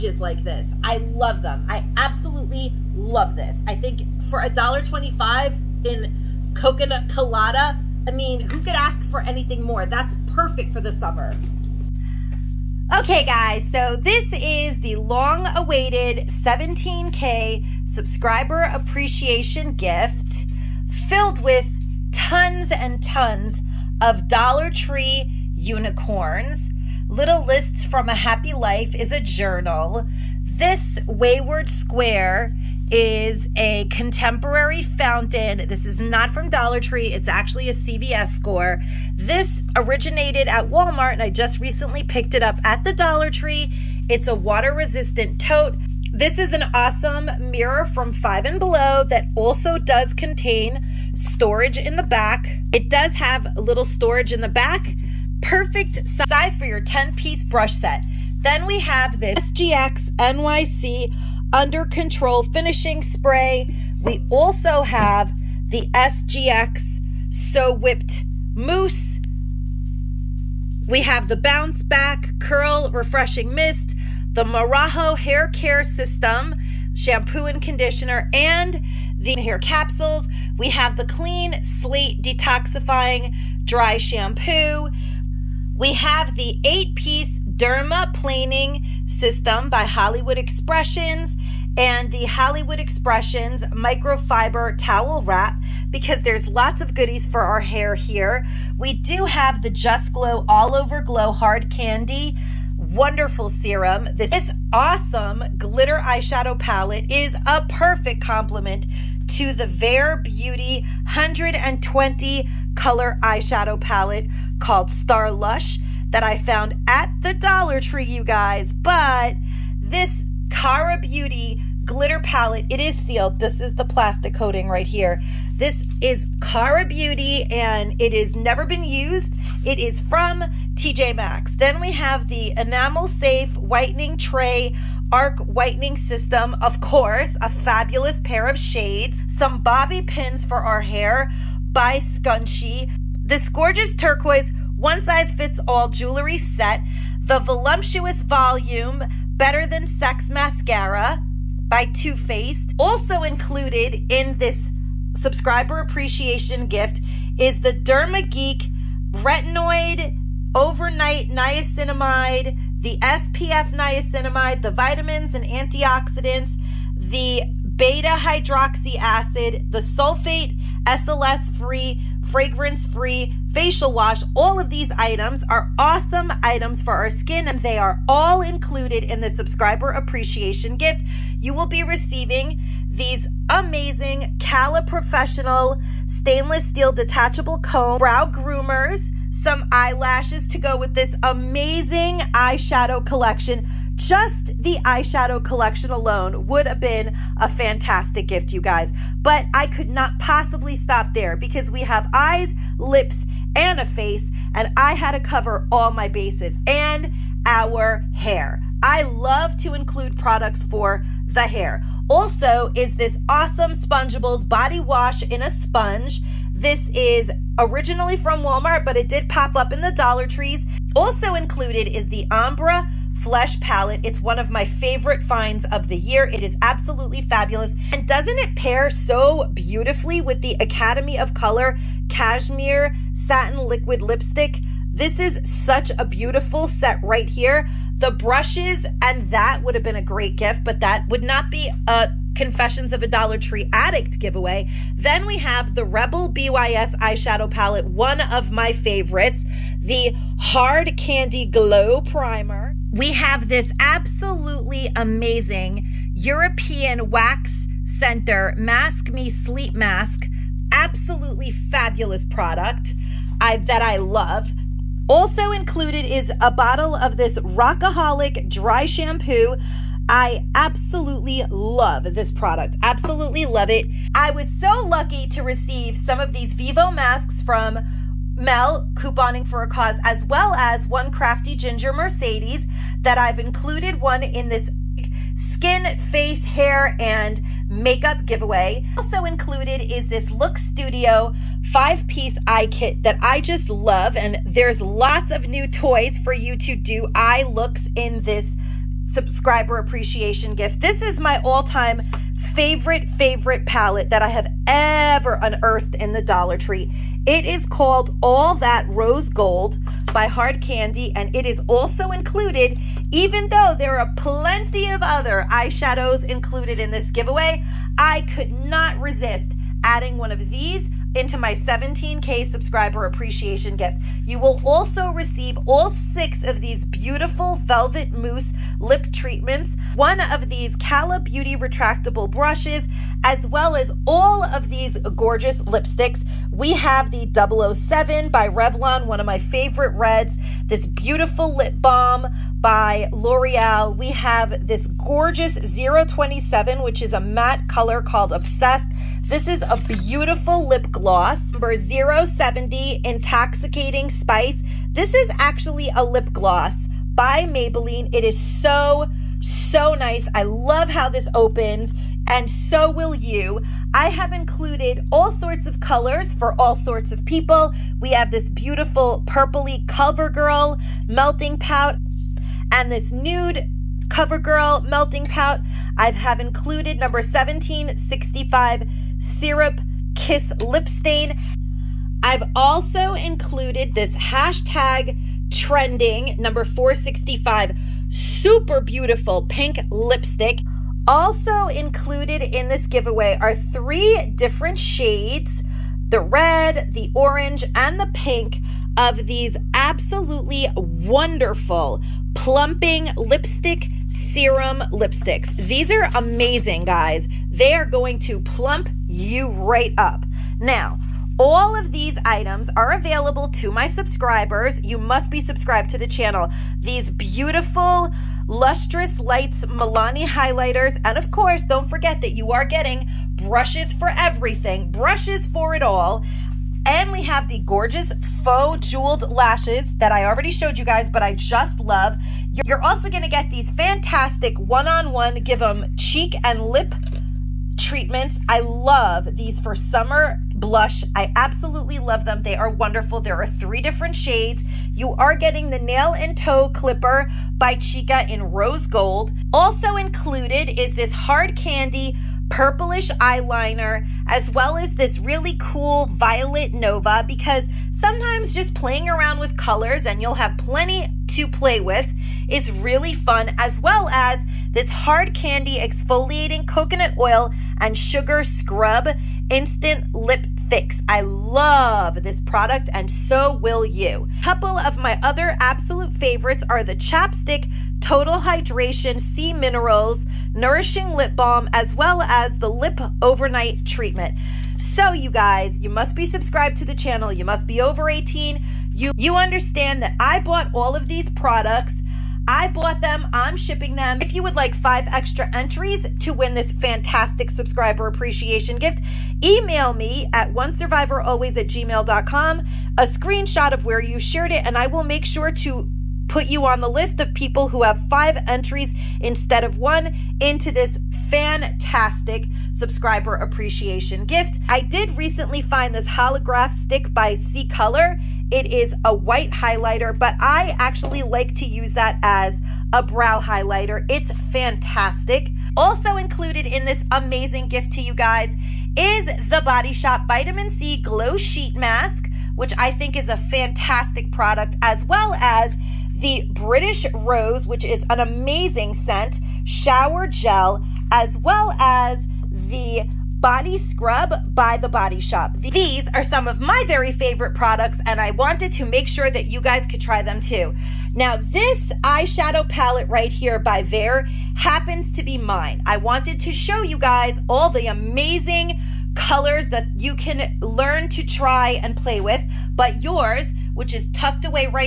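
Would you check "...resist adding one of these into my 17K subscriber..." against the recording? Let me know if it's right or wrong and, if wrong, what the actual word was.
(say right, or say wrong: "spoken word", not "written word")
right.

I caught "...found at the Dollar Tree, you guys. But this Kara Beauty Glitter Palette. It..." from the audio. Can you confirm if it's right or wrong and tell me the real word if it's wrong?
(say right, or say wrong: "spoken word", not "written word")
right.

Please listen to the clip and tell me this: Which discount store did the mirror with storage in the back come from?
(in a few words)
Five and Below.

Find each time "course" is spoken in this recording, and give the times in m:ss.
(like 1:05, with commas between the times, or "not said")
2:16, 7:01.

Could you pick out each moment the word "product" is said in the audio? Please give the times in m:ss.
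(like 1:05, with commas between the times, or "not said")
3:30, 4:22, 4:32, 7:52, 8:11, 8:54, 9:07.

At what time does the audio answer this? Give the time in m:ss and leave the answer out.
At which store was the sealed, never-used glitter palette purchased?
2:10.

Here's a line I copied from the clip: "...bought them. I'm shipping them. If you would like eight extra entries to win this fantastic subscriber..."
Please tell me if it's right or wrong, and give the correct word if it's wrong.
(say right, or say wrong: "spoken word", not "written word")
wrong: "five", not "eight".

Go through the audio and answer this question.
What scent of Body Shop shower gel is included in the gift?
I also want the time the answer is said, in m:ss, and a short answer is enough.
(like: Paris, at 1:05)
British Rose, at 8:56.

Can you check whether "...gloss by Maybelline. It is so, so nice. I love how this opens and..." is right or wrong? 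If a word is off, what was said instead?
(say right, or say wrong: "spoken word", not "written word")
right.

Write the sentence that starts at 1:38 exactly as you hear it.
We do have the Just Glow All Over Glow Hard Candy wonderful serum.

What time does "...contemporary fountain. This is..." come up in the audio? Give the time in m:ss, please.
0:33.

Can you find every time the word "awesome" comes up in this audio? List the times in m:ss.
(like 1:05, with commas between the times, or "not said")
0:46, 1:44, 2:55, 3:33.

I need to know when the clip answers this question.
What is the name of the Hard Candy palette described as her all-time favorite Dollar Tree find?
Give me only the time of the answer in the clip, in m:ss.
5:08.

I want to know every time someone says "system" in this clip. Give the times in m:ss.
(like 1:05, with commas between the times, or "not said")
1:15, 1:29, 2:15.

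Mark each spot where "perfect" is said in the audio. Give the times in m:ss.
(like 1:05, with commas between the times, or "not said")
0:10, 0:55, 1:47.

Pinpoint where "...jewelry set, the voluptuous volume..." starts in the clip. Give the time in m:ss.
2:25.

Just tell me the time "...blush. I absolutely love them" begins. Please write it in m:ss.
7:20.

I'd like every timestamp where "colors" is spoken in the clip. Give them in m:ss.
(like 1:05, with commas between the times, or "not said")
1:52, 3:51, 5:47, 6:05, 7:39, 8:37, 9:19.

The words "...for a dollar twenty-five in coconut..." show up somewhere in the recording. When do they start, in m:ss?
0:04.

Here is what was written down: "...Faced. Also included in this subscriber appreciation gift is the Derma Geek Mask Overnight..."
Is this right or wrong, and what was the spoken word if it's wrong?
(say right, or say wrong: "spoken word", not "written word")
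wrong: "Retinoid", not "Mask".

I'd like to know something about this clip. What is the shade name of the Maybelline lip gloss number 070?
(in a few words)
Intoxicating Spice.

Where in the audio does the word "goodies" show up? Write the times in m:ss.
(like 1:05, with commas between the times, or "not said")
1:36.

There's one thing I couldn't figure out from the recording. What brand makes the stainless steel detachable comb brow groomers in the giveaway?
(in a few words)
Cala Professional.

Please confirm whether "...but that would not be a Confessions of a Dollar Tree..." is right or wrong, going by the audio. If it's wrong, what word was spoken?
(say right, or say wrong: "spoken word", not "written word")
right.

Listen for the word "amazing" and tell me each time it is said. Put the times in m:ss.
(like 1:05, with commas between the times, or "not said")
3:03, 3:11, 4:14, 6:46, 8:47, 8:58, 9:17.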